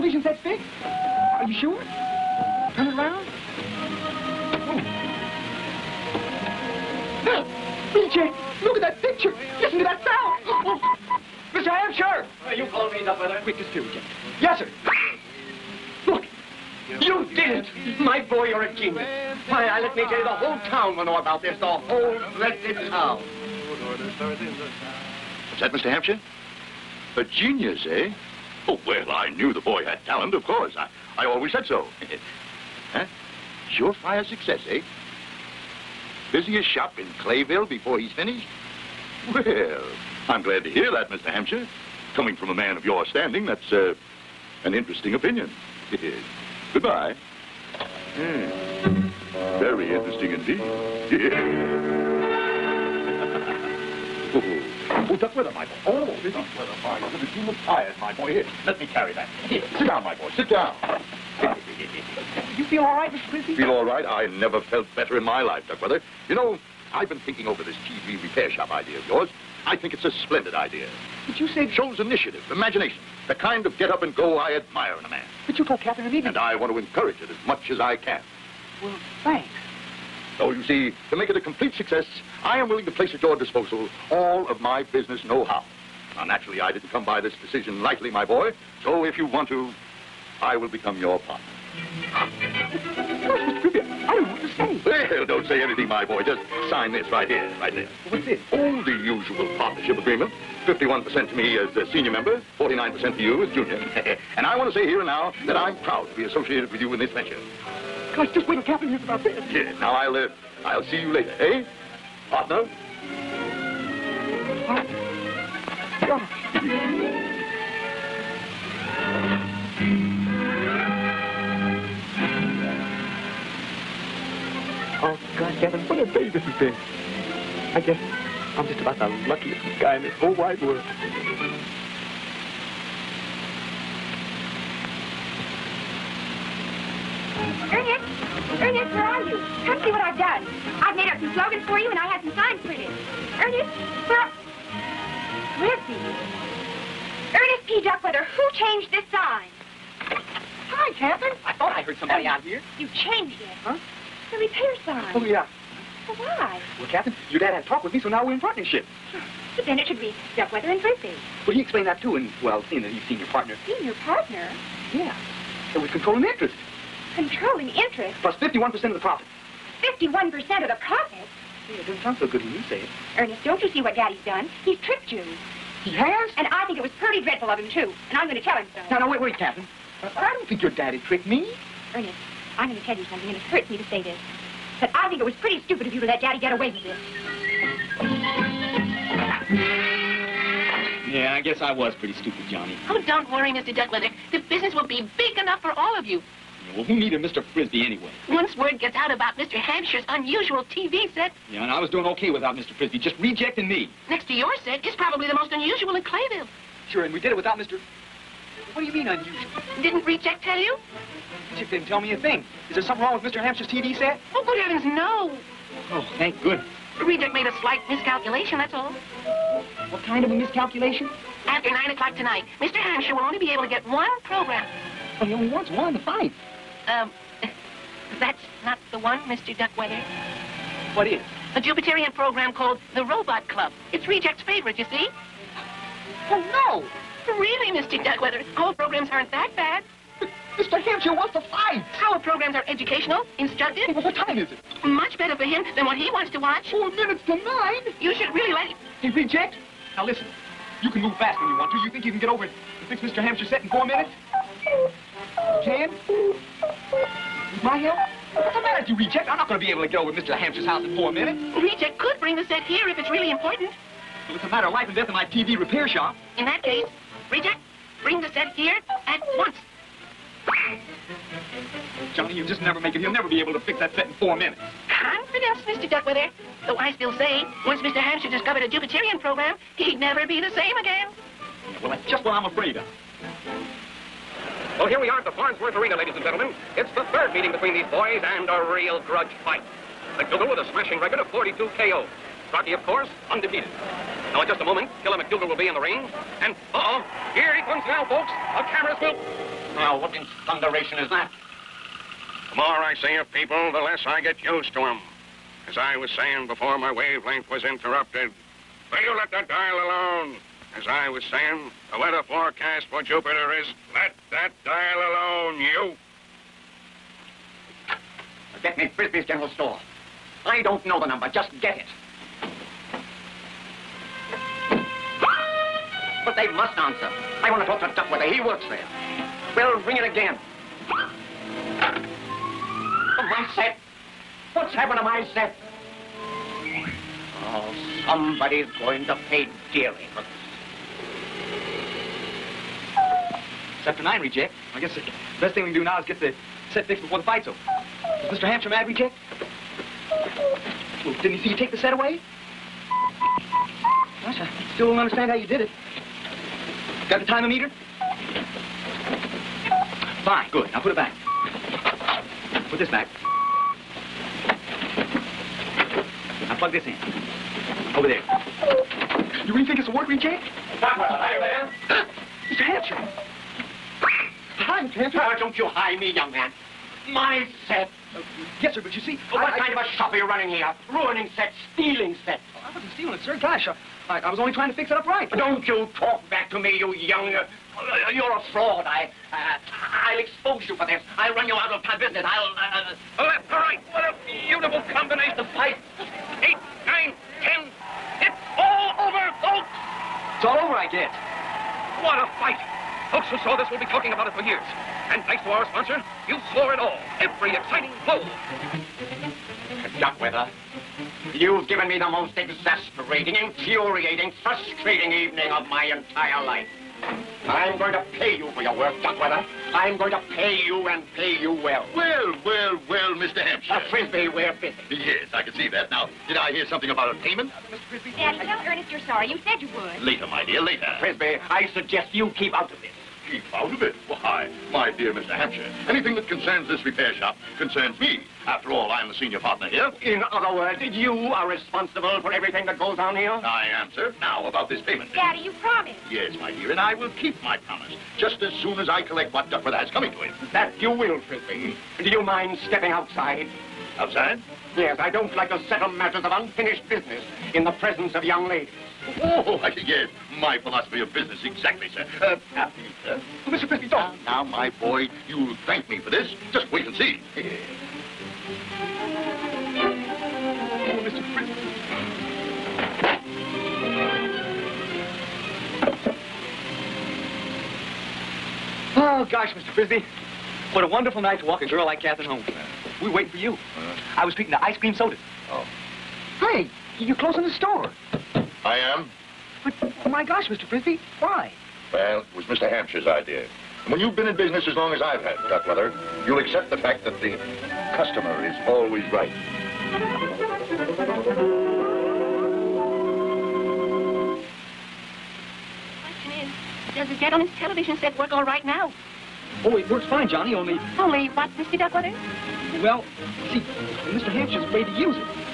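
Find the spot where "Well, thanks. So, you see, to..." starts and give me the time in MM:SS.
01:18.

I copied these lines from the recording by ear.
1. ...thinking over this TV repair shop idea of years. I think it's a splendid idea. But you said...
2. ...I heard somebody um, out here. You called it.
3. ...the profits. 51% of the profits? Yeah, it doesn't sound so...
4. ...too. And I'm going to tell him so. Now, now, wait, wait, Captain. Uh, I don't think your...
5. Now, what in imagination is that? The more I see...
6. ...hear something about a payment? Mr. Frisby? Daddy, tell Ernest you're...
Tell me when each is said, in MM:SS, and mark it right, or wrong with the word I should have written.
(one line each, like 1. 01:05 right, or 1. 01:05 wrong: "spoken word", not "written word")
1. 01:07 wrong: "yours", not "years"
2. 02:31 wrong: "changed", not "called"
3. 02:48 right
4. 02:57 right
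5. 04:59 wrong: "thunderation", not "imagination"
6. 07:06 right.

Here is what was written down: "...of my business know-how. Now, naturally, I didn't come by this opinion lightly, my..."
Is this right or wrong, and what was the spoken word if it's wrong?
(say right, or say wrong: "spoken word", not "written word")
wrong: "decision", not "opinion".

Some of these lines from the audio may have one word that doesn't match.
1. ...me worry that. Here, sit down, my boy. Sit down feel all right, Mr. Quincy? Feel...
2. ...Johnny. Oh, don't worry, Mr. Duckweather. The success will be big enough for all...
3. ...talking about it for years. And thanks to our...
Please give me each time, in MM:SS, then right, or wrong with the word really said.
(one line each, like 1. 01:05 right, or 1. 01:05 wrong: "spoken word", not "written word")
1. 00:58 wrong: "carry", not "worry"
2. 03:12 wrong: "business", not "success"
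3. 06:43 right.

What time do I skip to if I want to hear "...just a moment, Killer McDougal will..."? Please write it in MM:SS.
04:54.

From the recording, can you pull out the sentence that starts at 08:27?
gentleman's television set work all right now.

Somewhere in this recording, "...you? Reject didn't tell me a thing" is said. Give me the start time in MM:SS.
03:30.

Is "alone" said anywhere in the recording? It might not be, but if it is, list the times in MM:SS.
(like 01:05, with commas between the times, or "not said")
05:09, 05:14.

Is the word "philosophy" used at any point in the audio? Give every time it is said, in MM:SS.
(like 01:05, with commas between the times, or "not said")
07:40.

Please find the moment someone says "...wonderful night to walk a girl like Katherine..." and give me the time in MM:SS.
08:00.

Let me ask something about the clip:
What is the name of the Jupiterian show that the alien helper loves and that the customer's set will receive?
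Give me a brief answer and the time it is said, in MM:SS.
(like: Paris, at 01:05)
The Robot Club, at 03:52.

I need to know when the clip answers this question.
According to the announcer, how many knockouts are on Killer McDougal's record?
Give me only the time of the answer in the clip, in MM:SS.
04:51.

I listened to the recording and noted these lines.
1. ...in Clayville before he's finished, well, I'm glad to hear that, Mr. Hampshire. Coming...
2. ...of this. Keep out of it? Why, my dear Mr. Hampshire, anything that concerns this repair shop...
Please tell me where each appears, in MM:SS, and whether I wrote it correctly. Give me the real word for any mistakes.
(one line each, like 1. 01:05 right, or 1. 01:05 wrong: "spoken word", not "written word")
1. 00:36 right
2. 07:12 right.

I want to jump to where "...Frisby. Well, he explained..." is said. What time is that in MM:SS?
02:40.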